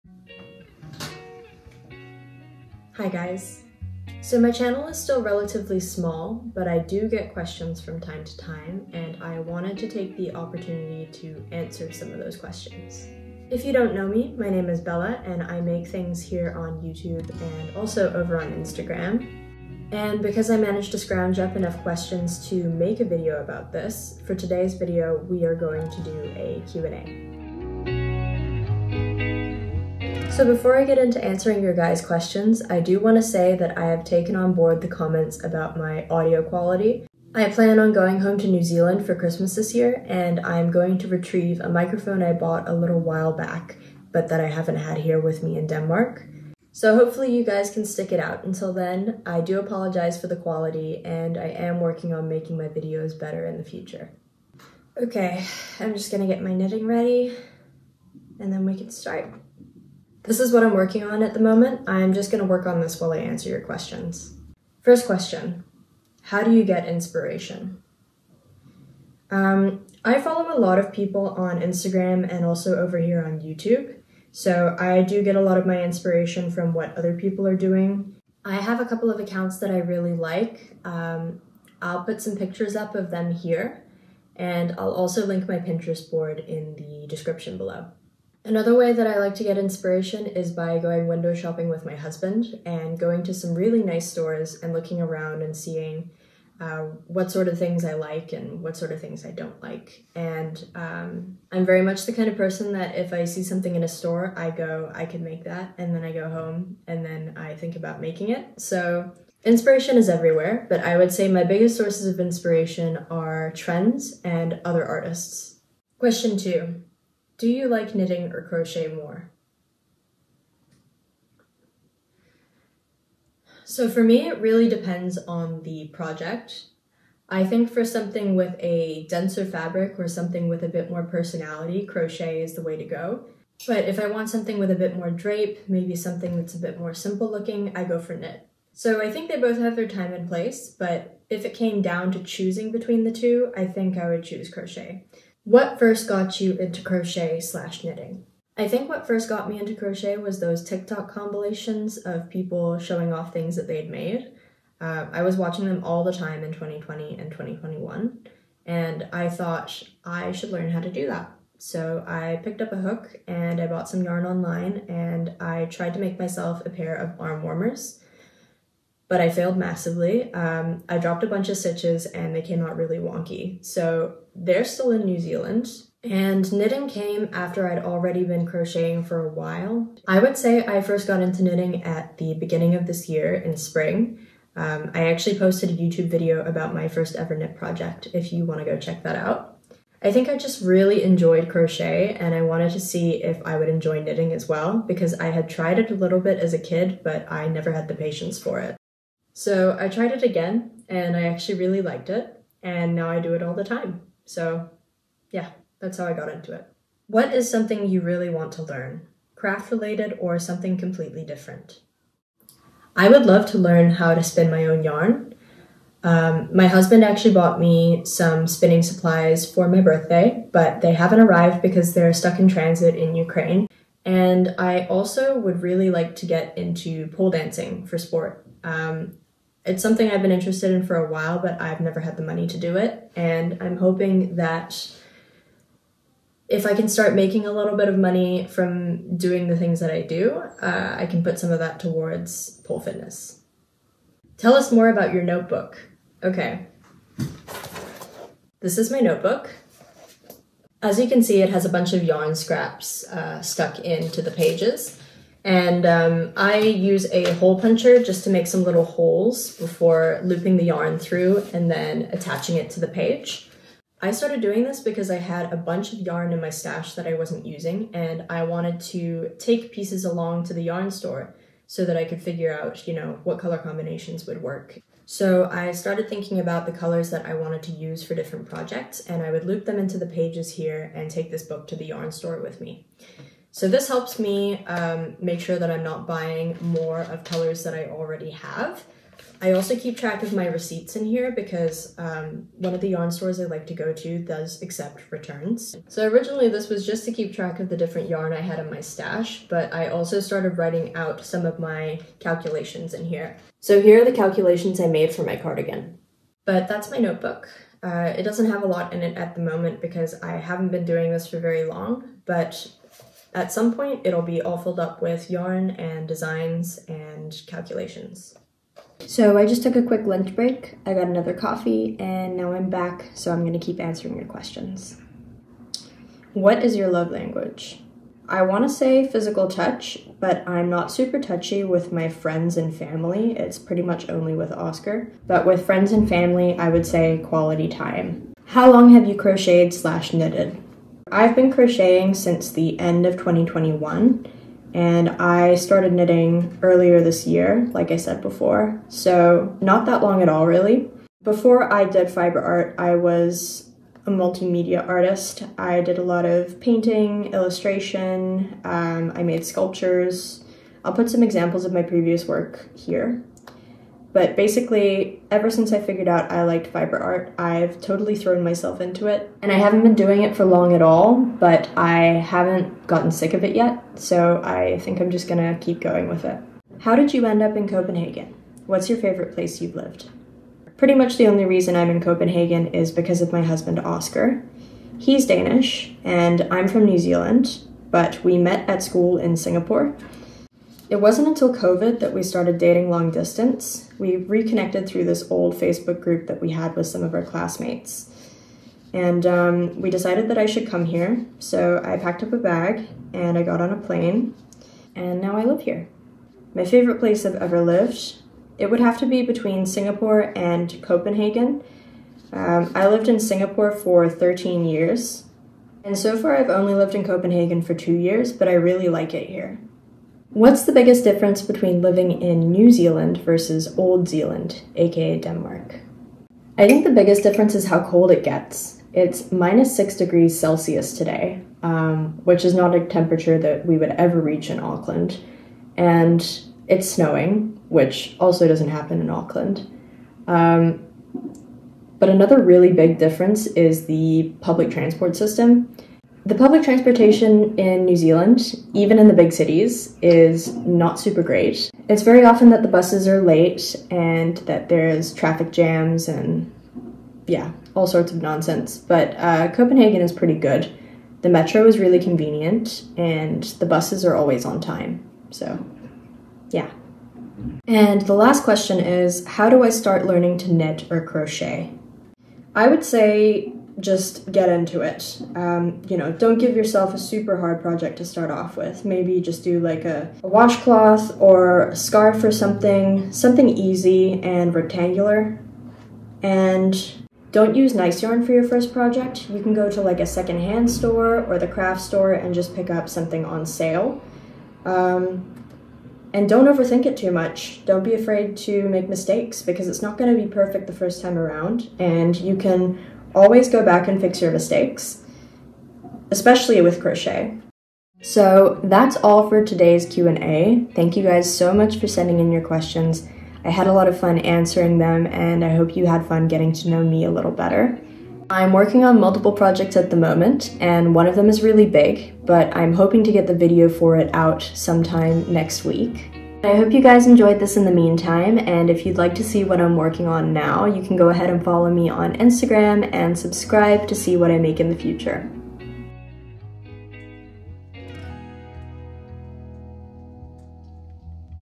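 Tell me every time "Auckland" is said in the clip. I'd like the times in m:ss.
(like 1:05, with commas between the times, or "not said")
7:14, 7:19.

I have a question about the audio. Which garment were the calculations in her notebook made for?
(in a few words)
Cardigan.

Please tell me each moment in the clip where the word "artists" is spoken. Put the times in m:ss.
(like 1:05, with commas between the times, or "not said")
1:54, 5:54.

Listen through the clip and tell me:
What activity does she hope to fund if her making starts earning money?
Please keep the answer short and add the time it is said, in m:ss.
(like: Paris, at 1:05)
Pole dancing, at 3:47.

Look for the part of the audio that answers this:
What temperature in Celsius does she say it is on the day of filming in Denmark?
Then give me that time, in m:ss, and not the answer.
7:09.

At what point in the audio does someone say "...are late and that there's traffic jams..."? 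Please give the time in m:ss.
7:33.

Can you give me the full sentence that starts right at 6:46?
My favorite place I've ever lived, it would have to be between Singapore and Copenhagen.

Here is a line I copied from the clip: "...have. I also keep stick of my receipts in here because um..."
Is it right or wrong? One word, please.
wrong.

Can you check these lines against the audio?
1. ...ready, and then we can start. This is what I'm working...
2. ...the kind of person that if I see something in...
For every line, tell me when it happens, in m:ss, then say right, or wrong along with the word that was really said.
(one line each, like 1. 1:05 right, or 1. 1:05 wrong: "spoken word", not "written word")
1. 0:56 right
2. 1:42 right.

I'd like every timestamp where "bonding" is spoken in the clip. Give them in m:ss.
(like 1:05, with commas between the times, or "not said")
not said.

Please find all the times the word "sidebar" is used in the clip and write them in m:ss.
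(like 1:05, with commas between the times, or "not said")
not said.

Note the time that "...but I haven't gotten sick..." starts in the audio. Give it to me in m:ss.
6:11.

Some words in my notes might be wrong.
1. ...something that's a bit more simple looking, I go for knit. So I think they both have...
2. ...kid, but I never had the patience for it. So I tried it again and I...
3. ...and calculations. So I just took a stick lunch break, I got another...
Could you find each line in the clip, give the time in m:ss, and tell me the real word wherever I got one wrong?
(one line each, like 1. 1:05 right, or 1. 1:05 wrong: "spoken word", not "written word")
1. 2:15 right
2. 3:16 right
3. 5:16 wrong: "quick", not "stick".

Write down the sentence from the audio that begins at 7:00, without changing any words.
What's the biggest difference between living in New Zealand versus Old Zealand, aka Denmark?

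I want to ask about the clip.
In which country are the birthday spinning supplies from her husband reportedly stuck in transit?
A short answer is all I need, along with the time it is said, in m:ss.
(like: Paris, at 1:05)
Ukraine, at 3:43.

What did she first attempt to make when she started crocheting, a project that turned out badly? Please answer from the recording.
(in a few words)
Arm warmers.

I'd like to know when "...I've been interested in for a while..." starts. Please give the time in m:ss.
3:50.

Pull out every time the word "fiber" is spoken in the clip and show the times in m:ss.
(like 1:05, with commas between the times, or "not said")
5:52, 6:06.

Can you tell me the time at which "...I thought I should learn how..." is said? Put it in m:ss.
2:39.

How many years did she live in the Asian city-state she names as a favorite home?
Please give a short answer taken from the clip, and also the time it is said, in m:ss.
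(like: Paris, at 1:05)
13, at 6:54.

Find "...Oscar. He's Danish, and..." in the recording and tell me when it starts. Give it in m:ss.
6:23.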